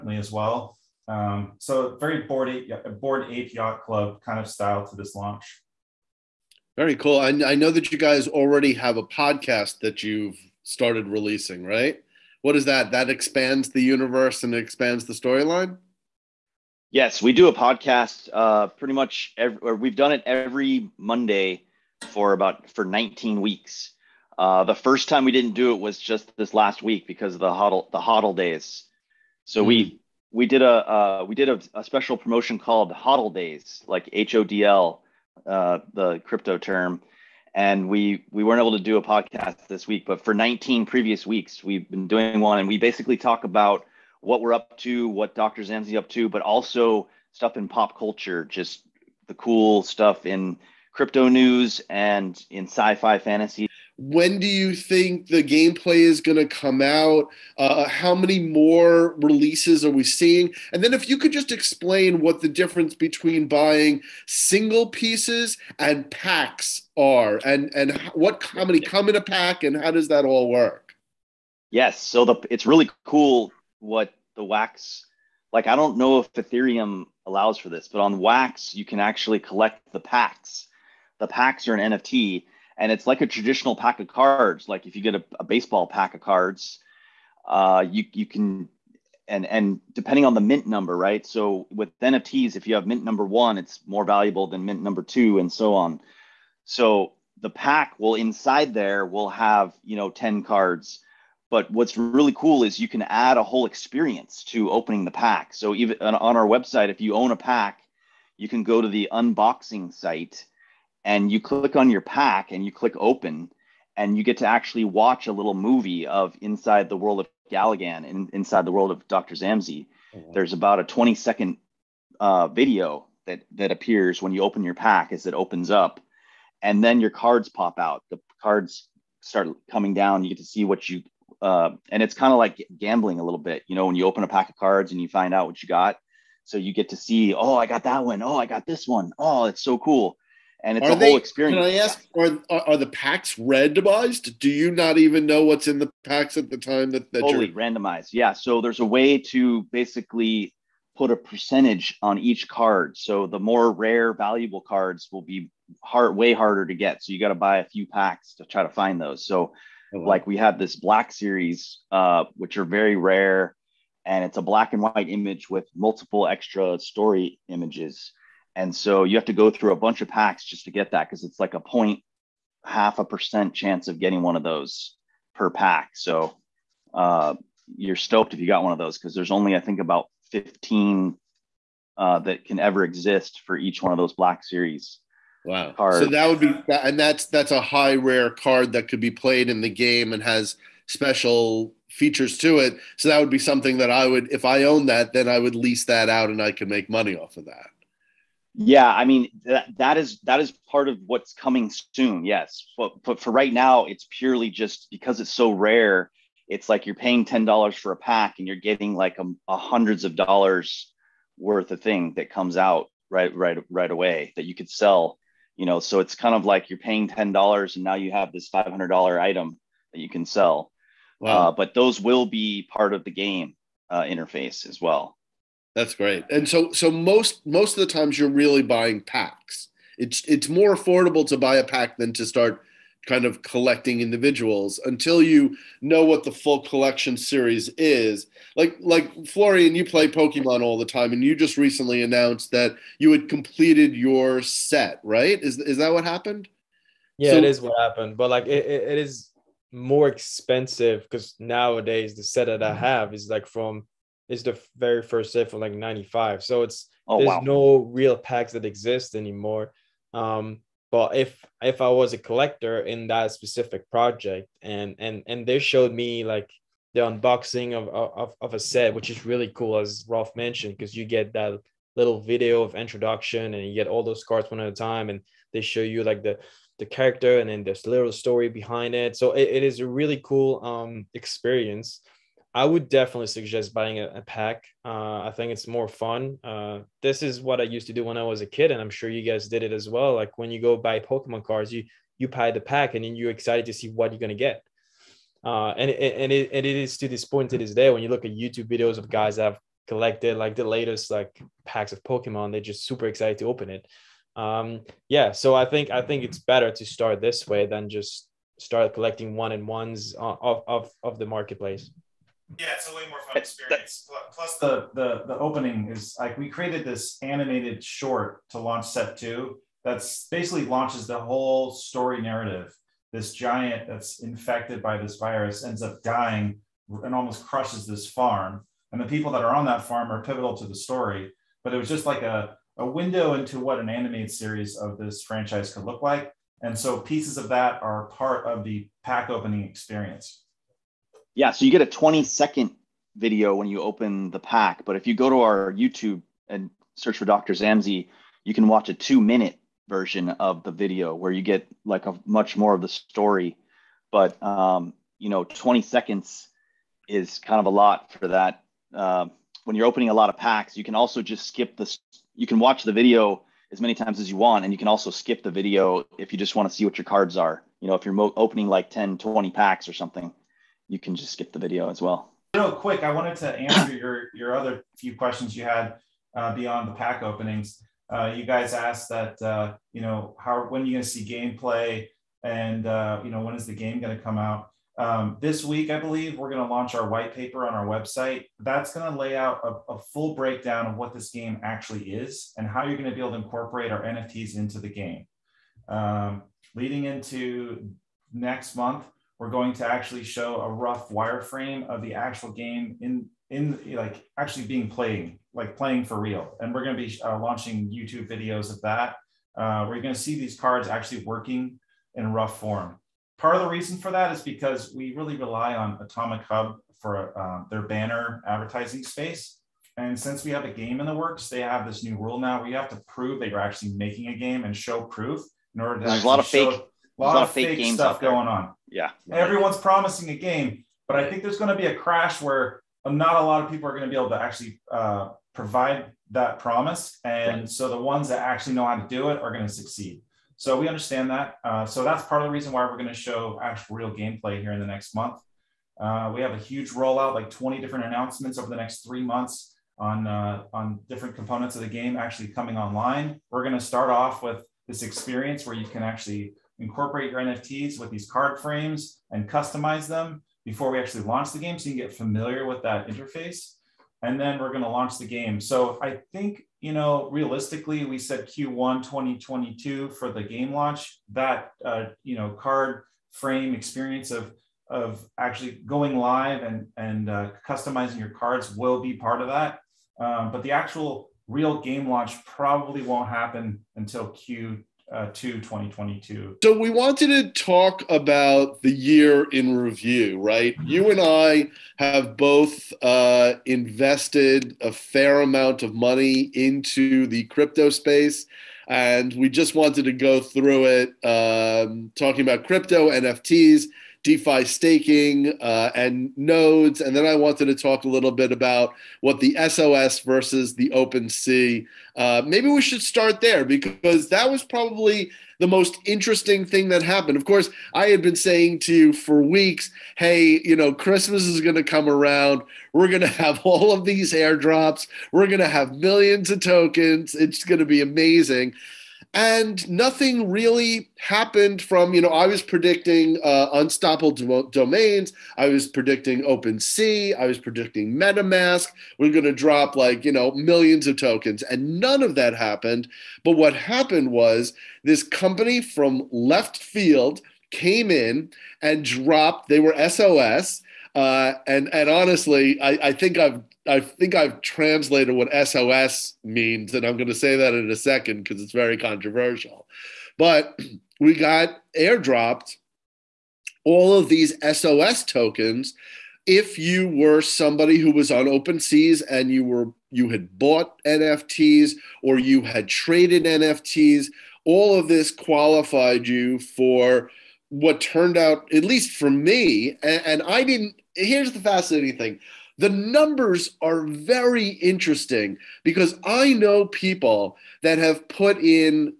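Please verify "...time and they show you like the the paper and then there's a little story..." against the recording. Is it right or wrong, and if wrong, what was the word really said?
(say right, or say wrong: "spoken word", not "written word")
wrong: "character", not "paper".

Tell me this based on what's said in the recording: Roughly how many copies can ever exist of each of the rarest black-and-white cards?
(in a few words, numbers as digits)
15.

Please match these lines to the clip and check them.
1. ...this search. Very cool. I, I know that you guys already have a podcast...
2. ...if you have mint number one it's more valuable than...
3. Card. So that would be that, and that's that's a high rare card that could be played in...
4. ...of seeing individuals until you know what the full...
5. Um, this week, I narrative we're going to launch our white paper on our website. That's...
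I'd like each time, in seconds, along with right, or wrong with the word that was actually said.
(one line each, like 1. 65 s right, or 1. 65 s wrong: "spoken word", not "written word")
1. 4 s wrong: "launch", not "search"
2. 92 s right
3. 185 s right
4. 233 s wrong: "collecting", not "seeing"
5. 384 s wrong: "believe", not "narrative".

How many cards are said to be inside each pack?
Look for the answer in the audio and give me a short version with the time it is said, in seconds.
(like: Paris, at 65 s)
10, at 100 s.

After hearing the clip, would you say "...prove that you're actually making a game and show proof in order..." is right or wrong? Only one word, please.
right.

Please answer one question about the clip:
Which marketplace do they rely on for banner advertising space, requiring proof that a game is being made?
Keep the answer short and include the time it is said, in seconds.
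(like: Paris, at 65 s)
Atomic Hub, at 416 s.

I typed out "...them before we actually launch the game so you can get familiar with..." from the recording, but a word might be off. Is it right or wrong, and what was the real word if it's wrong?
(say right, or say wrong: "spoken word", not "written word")
right.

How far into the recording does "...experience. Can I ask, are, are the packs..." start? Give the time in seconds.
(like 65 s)
141 s.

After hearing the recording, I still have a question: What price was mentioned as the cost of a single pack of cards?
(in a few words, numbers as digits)
$10.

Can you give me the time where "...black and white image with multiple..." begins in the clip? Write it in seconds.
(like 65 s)
164 s.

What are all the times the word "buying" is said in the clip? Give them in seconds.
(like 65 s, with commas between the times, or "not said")
63 s, 228 s, 283 s.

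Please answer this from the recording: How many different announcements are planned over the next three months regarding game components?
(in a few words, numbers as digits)
20.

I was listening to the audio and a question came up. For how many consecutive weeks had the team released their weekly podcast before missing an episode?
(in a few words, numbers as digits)
19.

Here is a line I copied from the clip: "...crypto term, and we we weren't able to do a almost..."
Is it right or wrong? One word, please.
wrong.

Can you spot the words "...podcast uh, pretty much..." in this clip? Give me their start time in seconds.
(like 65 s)
17 s.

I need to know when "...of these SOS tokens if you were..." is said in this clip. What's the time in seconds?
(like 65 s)
564 s.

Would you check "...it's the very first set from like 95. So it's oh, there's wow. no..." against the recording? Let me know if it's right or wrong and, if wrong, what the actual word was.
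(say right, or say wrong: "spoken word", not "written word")
right.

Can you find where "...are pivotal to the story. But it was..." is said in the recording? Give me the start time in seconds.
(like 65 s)
330 s.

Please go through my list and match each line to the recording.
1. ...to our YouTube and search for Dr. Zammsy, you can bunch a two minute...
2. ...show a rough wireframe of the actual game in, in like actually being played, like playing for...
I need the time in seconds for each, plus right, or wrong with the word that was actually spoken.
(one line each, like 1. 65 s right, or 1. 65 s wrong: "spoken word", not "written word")
1. 345 s wrong: "watch", not "bunch"
2. 400 s right.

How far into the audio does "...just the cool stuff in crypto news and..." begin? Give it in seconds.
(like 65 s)
48 s.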